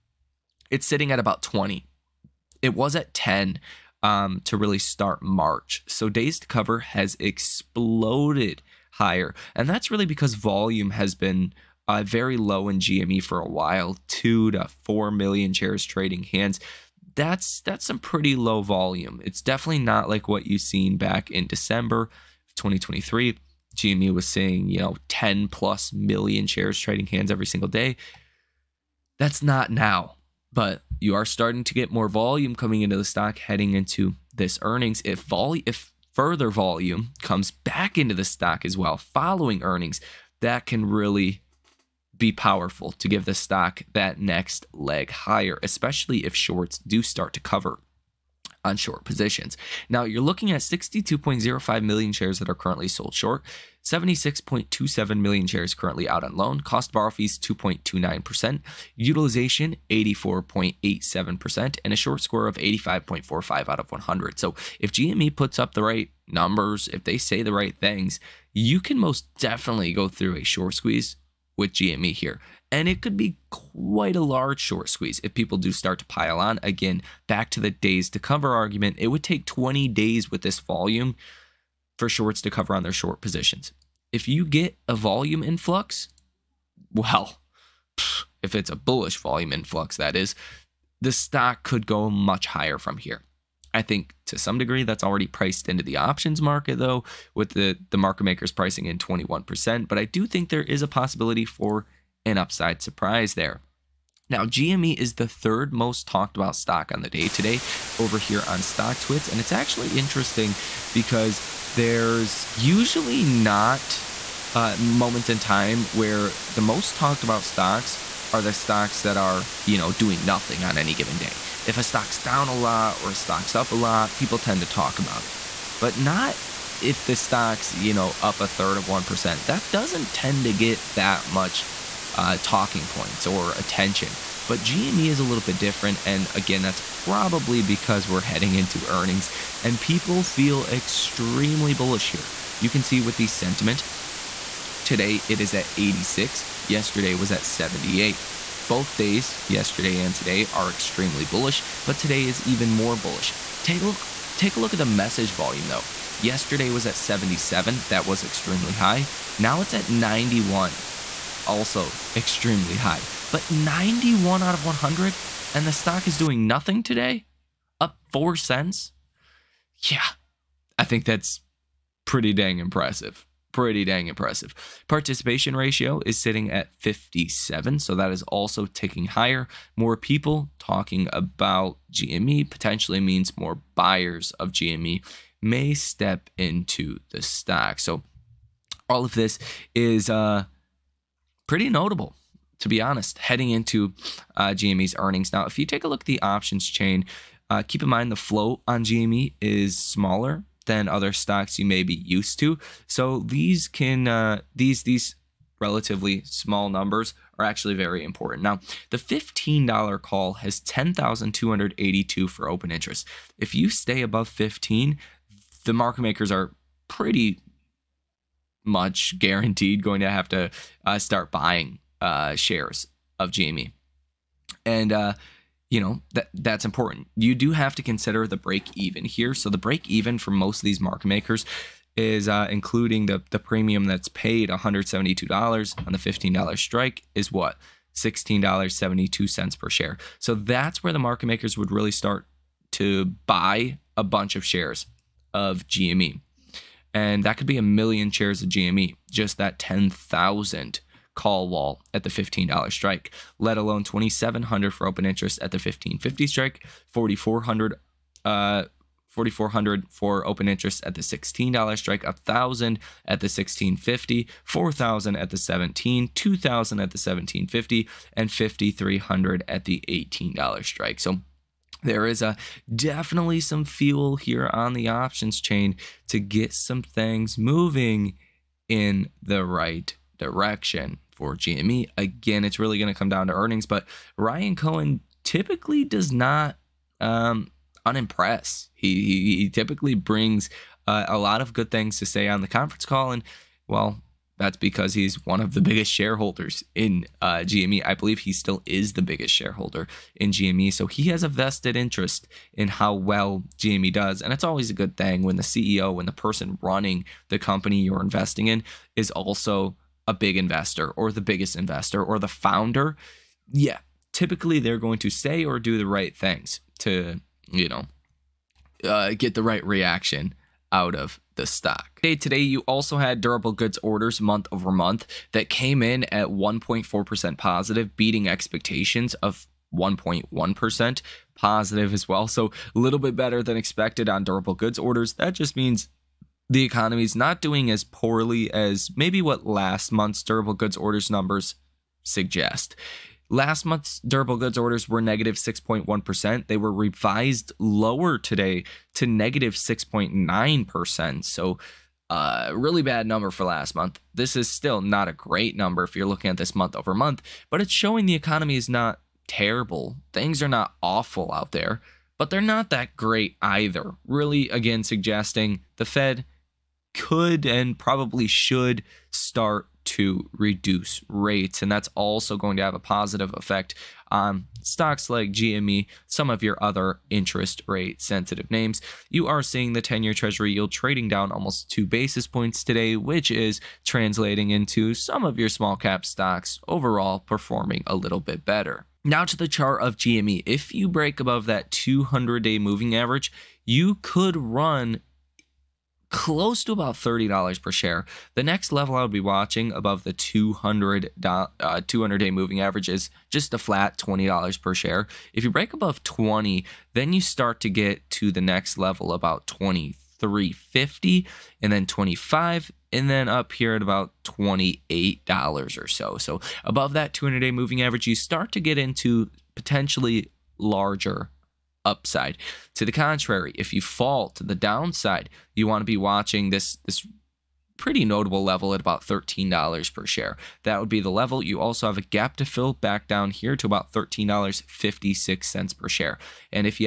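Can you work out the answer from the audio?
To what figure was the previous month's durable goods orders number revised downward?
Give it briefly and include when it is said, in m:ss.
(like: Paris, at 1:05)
-6.9%, at 5:49.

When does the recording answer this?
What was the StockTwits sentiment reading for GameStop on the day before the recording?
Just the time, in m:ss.
2:27.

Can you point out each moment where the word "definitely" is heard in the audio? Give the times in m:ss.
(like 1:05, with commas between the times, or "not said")
0:19, 1:09, 4:32.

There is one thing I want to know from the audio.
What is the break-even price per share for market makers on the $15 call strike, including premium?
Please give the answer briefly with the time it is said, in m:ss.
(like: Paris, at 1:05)
$16.72, at 3:57.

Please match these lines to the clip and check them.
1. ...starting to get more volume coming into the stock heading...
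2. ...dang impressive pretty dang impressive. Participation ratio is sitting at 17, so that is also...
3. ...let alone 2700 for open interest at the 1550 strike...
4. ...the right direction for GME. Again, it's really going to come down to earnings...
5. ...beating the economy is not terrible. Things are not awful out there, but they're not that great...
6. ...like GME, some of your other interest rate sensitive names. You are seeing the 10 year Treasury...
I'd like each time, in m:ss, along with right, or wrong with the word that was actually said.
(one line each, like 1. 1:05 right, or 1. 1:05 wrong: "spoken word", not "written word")
1. 0:31 right
2. 2:52 wrong: "57", not "17"
3. 4:13 right
4. 4:39 right
5. 5:57 wrong: "showing", not "beating"
6. 6:15 right.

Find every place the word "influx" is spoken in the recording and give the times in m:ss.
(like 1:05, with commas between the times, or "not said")
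1:25, 1:29.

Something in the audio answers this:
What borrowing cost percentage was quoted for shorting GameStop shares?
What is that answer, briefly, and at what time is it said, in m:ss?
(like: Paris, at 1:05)
2.29%, at 0:57.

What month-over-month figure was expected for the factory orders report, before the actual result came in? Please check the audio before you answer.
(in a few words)
1.1%.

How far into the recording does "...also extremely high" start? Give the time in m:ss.
2:41.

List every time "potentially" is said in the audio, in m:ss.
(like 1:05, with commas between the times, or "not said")
3:02, 6:59.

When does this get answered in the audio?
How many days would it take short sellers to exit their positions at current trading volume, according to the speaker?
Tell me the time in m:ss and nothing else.
1:19.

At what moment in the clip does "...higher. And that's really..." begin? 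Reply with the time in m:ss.
0:08.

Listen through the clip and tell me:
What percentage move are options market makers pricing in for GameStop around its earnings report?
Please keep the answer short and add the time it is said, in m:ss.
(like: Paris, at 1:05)
21%, at 1:38.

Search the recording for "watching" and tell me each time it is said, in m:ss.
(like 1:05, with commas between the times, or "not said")
6:39, 7:05.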